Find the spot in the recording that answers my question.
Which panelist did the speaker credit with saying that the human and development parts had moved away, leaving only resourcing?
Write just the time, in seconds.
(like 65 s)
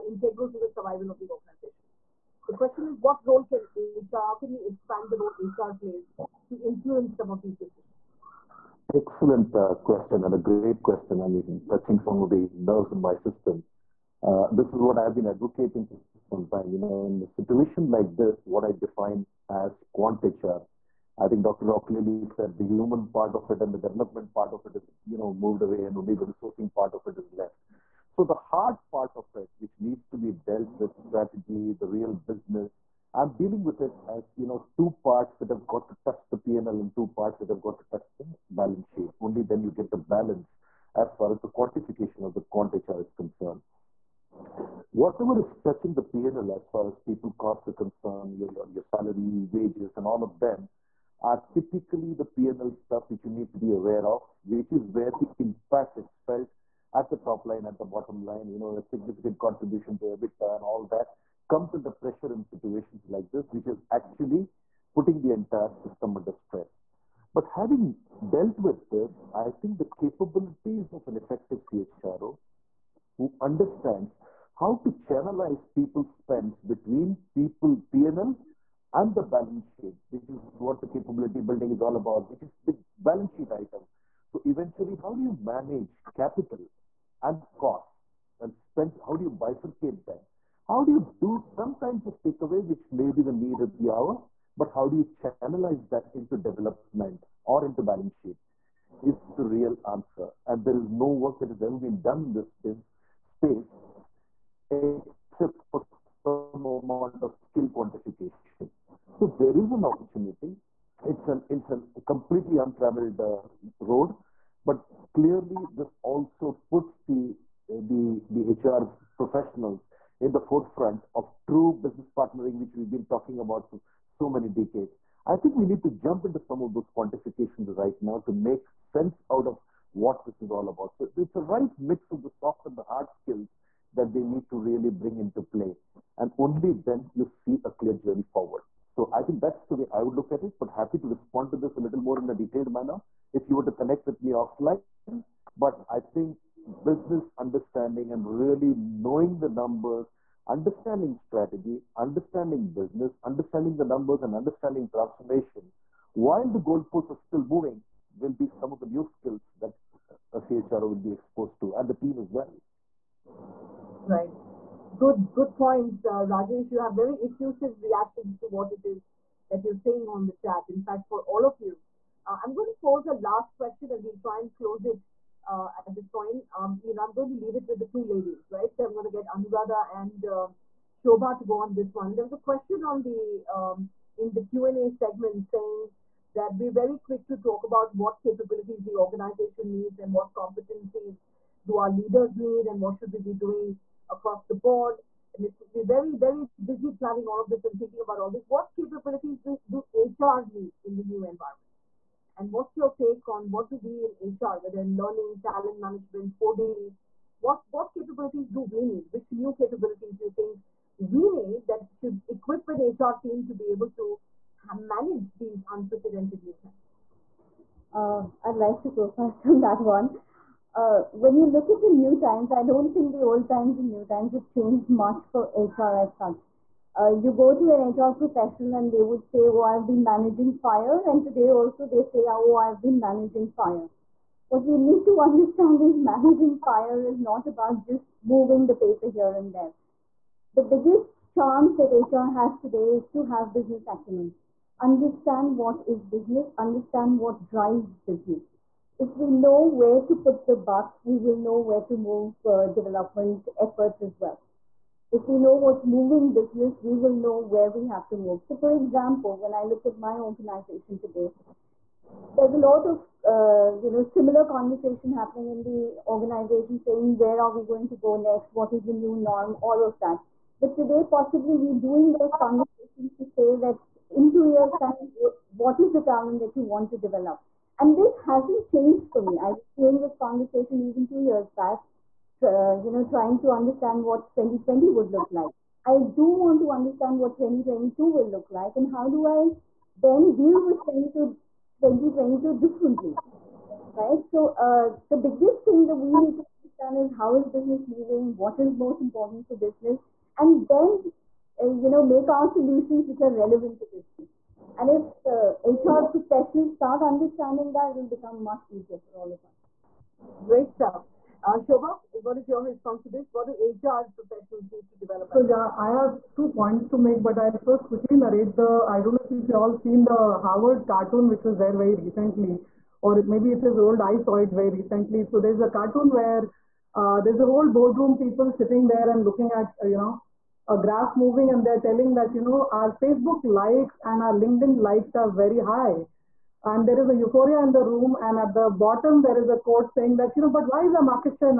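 21 s.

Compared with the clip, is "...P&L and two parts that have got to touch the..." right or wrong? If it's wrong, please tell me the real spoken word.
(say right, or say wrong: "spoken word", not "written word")
right.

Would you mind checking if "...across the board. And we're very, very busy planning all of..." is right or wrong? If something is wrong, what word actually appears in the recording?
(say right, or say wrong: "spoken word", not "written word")
right.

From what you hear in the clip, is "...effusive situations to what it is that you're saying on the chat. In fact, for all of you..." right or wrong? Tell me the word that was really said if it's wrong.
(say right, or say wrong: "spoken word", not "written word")
wrong: "reactions", not "situations".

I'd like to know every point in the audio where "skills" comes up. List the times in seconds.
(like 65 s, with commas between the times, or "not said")
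107 s, 133 s, 159 s.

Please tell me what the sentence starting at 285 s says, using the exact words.
I do want to understand what 2022 will look like and how do I then deal with 2022, 2022 differently, right?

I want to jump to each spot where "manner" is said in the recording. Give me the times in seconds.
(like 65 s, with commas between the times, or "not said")
142 s.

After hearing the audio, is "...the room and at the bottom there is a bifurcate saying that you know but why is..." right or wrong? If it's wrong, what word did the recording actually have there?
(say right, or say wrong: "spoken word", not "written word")
wrong: "quote", not "bifurcate".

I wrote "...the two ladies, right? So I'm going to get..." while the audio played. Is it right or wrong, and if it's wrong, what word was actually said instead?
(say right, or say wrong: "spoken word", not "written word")
right.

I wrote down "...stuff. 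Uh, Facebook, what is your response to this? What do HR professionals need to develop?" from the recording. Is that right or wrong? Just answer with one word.
wrong.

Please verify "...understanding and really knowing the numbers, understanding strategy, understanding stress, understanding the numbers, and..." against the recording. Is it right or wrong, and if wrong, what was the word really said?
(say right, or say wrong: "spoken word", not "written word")
wrong: "business", not "stress".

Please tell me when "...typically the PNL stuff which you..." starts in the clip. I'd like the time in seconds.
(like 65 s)
51 s.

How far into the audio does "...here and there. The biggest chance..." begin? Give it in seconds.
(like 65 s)
239 s.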